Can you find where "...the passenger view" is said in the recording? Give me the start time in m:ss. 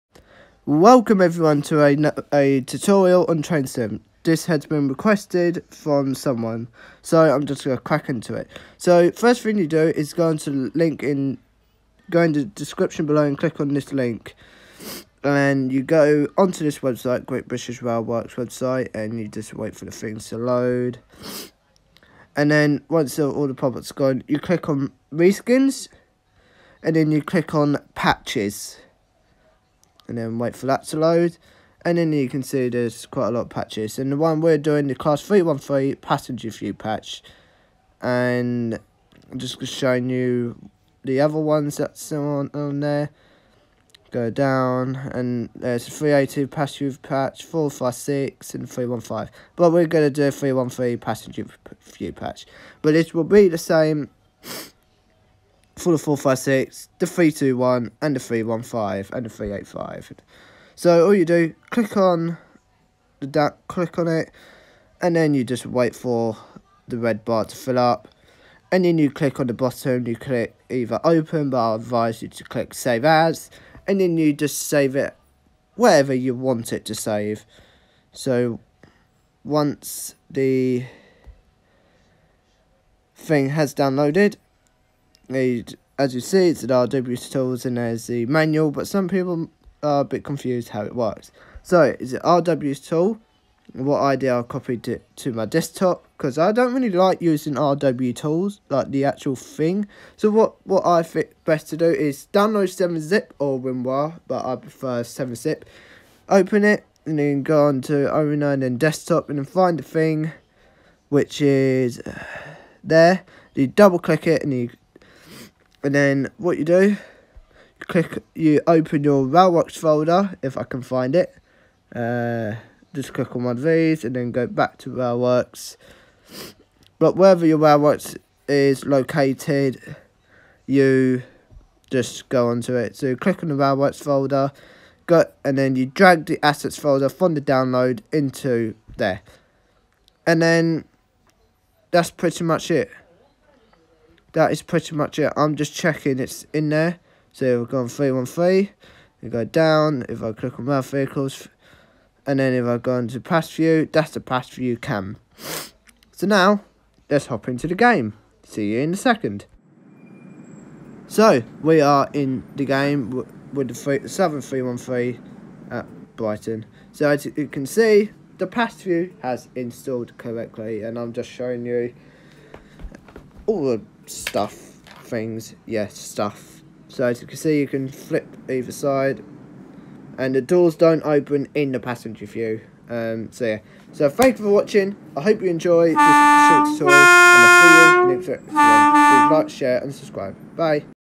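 3:01.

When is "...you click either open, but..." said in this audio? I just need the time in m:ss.
1:10.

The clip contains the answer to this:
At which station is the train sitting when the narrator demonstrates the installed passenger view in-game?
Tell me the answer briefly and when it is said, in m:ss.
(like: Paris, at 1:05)
Brighton, at 2:46.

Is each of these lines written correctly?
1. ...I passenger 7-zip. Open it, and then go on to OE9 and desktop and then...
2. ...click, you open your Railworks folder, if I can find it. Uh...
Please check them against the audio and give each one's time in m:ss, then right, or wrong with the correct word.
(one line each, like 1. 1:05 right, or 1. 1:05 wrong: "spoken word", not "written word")
1. 1:44 wrong: "prefer", not "passenger"
2. 1:57 right.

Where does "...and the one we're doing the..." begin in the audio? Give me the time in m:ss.
0:33.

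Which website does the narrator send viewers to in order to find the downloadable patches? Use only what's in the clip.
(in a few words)
Great British Rail Works.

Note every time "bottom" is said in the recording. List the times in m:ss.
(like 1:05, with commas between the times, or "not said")
1:09.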